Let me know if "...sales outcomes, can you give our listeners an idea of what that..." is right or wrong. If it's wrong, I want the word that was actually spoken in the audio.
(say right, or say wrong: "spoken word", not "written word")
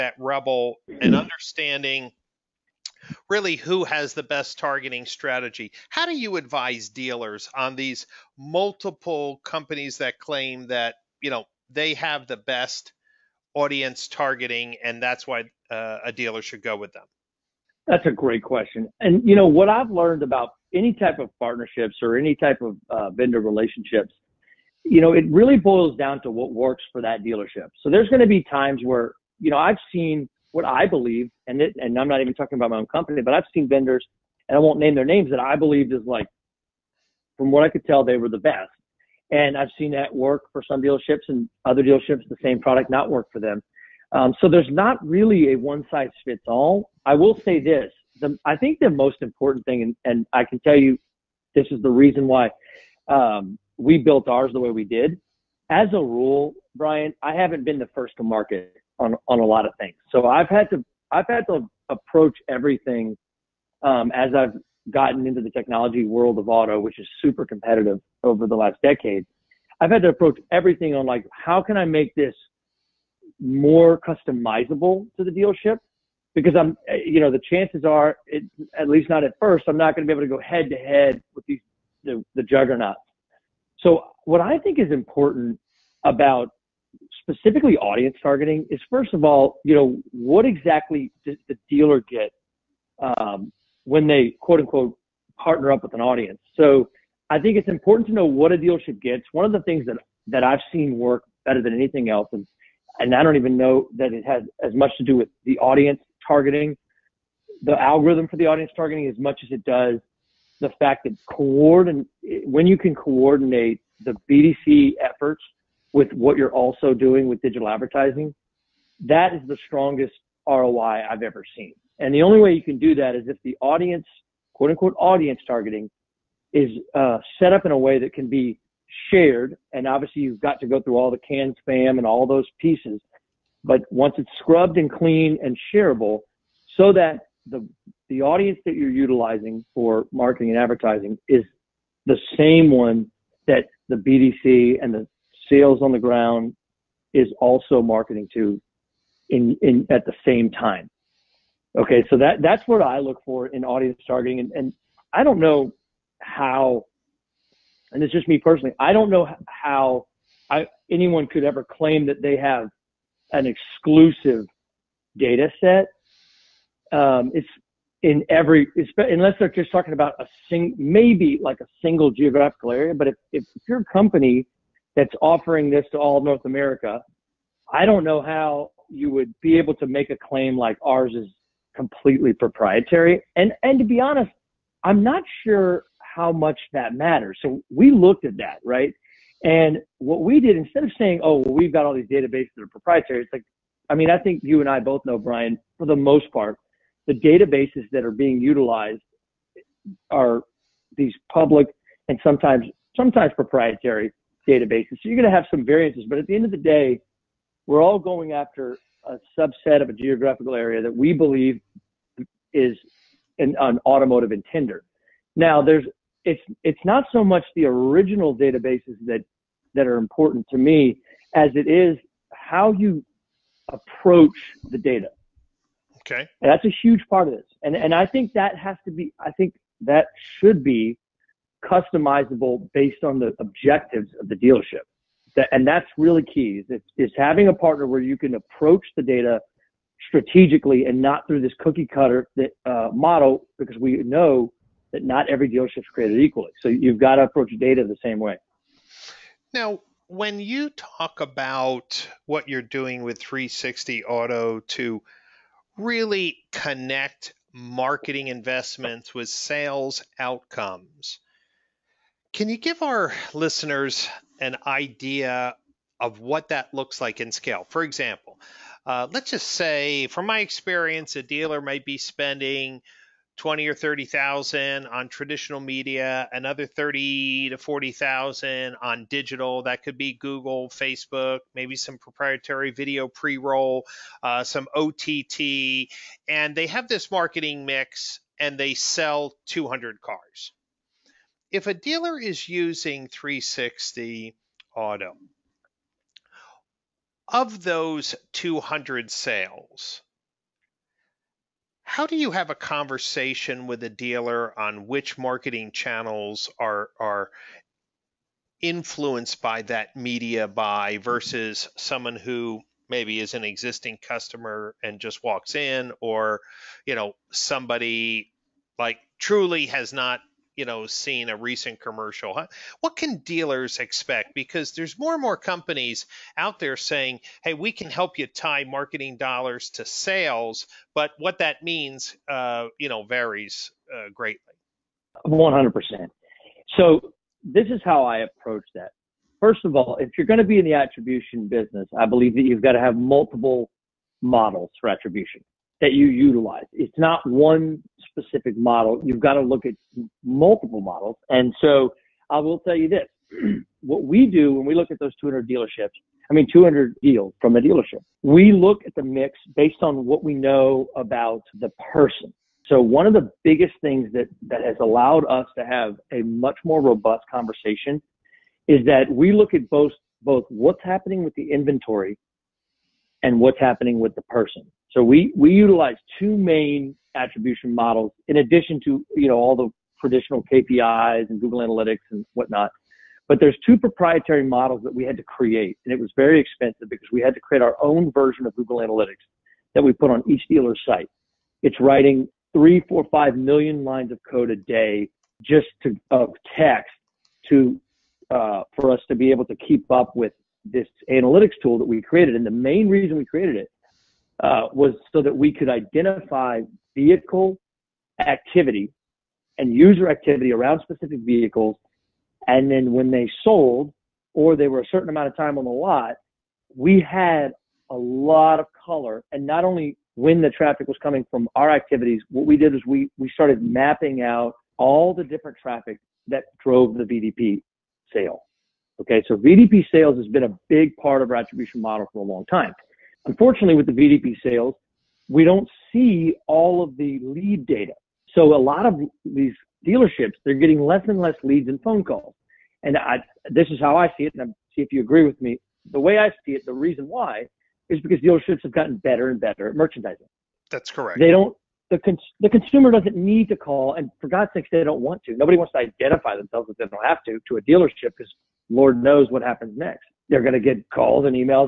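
right.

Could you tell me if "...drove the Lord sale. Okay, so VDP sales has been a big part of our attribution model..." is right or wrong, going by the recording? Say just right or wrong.
wrong.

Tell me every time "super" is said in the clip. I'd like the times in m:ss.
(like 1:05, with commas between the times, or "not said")
1:07.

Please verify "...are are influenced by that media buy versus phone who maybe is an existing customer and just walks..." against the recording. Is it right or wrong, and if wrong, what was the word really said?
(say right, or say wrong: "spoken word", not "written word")
wrong: "someone", not "phone".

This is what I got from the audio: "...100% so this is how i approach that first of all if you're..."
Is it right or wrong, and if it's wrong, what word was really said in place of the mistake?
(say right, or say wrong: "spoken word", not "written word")
right.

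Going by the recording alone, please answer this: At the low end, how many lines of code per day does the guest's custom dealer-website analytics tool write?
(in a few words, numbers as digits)
3 million.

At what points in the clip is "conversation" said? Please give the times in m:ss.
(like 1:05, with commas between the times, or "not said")
5:02, 6:07.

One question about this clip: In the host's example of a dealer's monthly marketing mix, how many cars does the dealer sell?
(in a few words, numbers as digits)
200.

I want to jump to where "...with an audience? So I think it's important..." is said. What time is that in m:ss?
1:35.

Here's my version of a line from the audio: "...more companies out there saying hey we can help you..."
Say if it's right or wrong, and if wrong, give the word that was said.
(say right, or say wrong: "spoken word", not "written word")
right.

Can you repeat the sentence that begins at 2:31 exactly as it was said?
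Okay, so that that's what I look for in audience targeting, and, and I don't know how, and it's just me personally.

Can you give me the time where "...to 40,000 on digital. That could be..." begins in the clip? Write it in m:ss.
4:37.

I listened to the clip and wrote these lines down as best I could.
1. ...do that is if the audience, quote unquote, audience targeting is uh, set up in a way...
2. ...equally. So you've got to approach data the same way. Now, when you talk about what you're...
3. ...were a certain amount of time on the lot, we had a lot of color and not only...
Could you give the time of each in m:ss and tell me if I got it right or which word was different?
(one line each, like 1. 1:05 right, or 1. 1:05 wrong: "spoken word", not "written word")
1. 2:02 right
2. 4:06 right
3. 6:54 right.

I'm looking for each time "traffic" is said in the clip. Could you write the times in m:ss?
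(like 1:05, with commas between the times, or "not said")
7:00, 7:05.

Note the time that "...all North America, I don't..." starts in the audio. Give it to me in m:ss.
2:55.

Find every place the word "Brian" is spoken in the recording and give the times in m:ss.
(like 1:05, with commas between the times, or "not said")
0:56, 3:15.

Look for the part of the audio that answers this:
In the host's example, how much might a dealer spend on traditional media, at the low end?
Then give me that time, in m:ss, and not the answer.
4:33.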